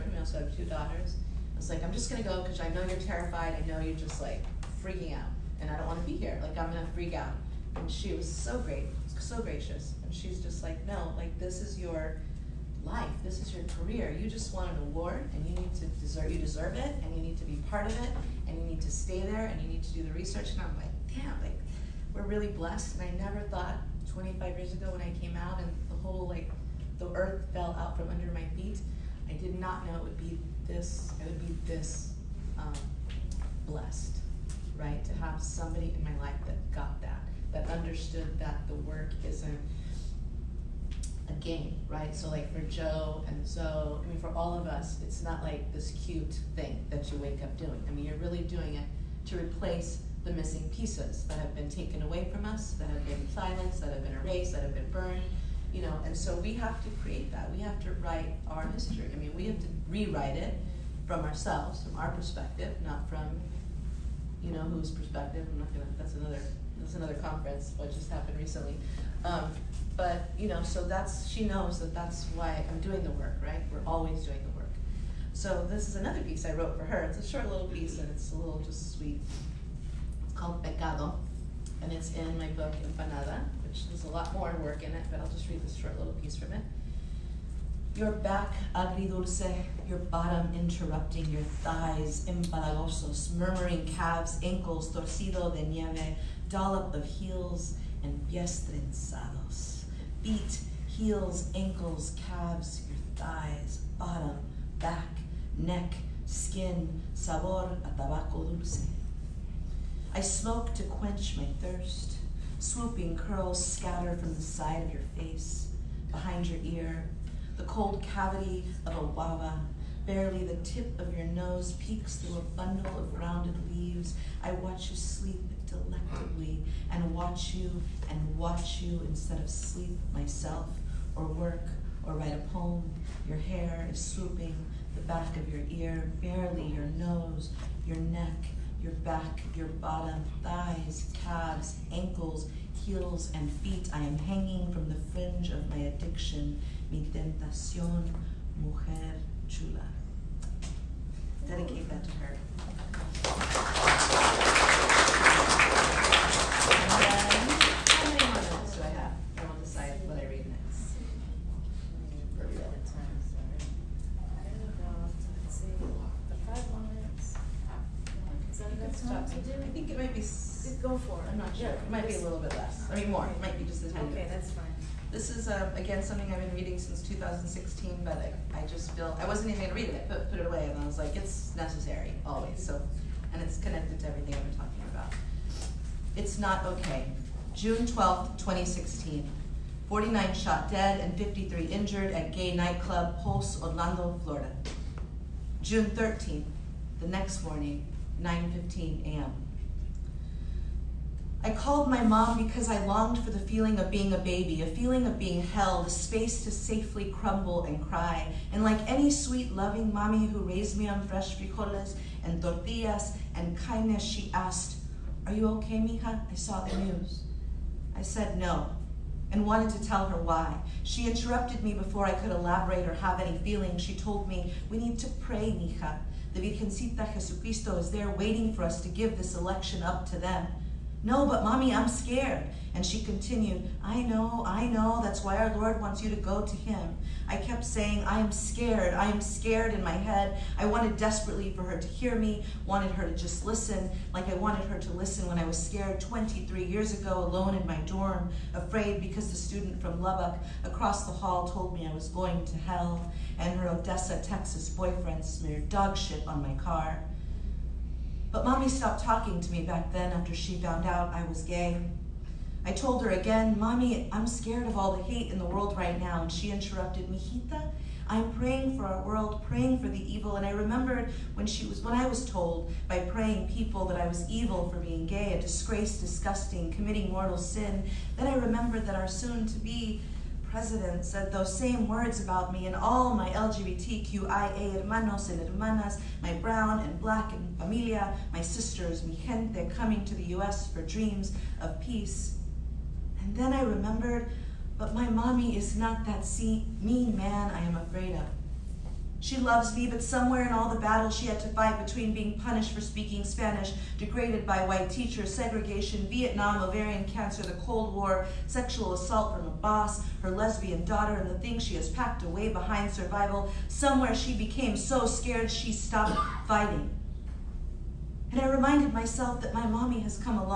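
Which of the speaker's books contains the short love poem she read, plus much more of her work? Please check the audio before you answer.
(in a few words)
Empanada.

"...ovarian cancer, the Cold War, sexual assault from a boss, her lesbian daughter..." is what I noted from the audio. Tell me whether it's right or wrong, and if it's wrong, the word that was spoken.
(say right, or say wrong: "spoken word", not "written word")
right.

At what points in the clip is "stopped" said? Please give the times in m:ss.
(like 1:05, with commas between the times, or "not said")
4:18, 5:15.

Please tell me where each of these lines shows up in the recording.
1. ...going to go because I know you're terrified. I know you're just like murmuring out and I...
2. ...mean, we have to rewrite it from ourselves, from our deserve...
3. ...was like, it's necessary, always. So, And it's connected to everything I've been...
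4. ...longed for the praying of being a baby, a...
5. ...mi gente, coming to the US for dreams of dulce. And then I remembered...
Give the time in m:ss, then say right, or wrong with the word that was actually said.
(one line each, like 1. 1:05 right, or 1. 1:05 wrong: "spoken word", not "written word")
1. 0:02 wrong: "freaking", not "murmuring"
2. 0:59 wrong: "perspective", not "deserve"
3. 3:00 right
4. 3:22 wrong: "feeling", not "praying"
5. 4:49 wrong: "peace", not "dulce".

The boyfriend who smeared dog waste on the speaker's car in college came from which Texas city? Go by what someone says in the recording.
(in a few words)
Odessa.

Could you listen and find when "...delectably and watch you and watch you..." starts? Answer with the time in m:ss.
2:05.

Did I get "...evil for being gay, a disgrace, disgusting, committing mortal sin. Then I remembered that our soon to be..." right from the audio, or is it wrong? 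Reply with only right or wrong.
right.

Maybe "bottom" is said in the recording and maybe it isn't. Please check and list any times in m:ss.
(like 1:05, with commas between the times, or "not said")
1:29, 1:43, 2:19.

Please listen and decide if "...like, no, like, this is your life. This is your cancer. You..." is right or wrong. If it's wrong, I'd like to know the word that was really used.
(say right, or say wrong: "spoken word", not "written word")
wrong: "career", not "cancer".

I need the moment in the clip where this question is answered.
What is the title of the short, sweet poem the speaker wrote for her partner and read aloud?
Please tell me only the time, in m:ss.
1:20.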